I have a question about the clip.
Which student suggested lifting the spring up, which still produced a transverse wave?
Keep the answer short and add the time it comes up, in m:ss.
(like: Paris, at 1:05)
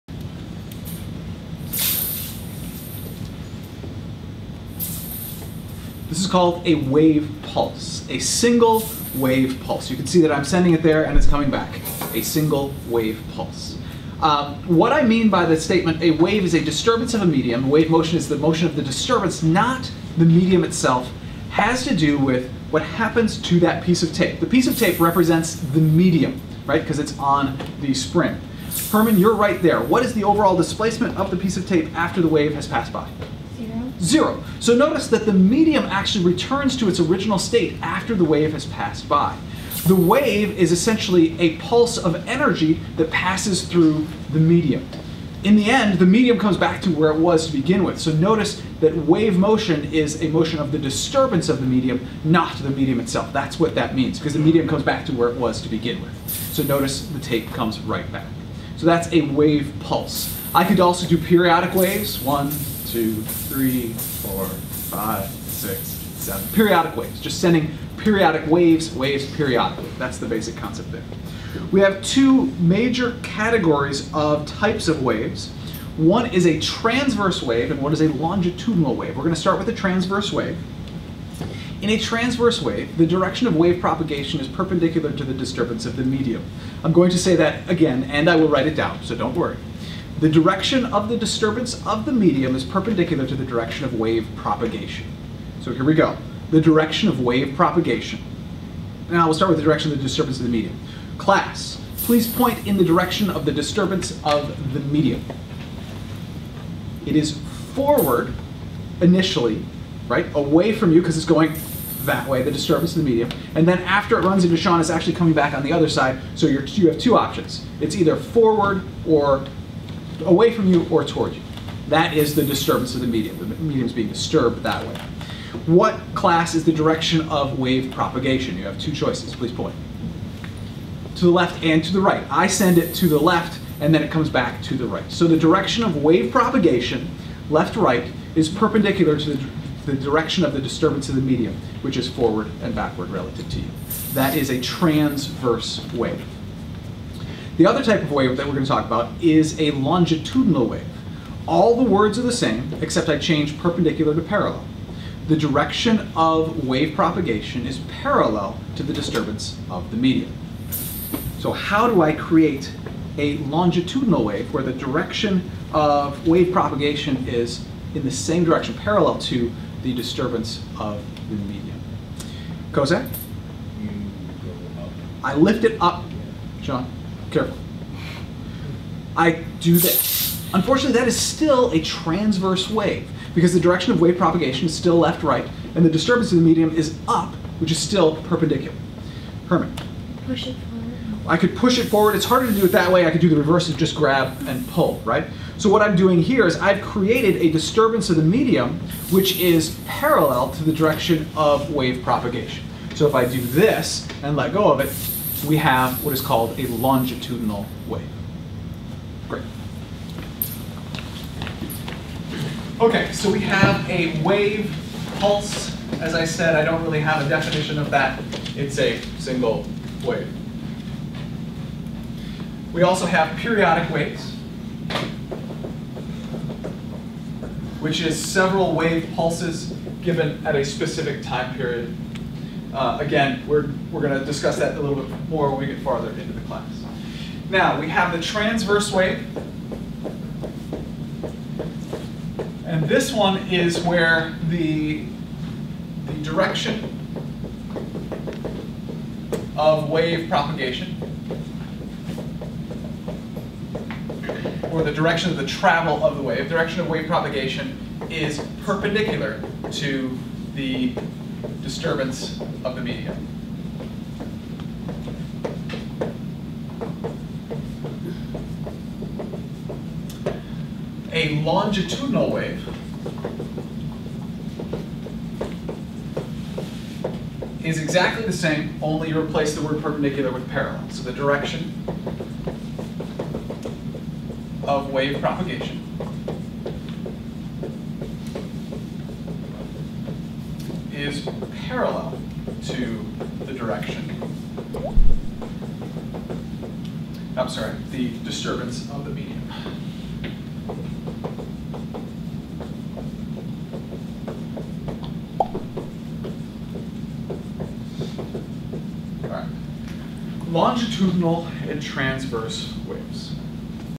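Kozak, at 2:52.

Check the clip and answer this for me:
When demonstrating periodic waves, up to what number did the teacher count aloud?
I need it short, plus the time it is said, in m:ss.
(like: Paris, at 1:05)
7, at 1:06.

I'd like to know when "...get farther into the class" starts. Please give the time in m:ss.
3:55.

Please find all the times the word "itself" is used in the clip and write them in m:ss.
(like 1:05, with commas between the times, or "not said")
0:20, 0:52.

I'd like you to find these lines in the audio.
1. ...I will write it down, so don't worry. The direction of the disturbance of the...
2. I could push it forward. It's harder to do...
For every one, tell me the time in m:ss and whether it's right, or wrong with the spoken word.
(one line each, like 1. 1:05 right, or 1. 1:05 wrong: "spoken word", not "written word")
1. 1:28 right
2. 3:11 right.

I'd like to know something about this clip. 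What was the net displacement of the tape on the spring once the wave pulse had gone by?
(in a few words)
0.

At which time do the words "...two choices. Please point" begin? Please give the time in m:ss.
2:08.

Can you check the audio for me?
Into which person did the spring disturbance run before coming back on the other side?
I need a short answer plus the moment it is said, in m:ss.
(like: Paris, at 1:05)
Sean, at 1:54.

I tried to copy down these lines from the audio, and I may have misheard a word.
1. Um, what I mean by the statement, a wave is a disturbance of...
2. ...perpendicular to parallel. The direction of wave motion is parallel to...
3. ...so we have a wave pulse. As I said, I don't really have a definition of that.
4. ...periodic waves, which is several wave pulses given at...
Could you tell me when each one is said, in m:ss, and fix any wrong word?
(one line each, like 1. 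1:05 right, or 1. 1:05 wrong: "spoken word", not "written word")
1. 0:14 right
2. 2:33 wrong: "propagation", not "motion"
3. 3:33 right
4. 3:43 right.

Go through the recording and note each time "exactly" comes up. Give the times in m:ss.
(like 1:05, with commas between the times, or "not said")
4:37.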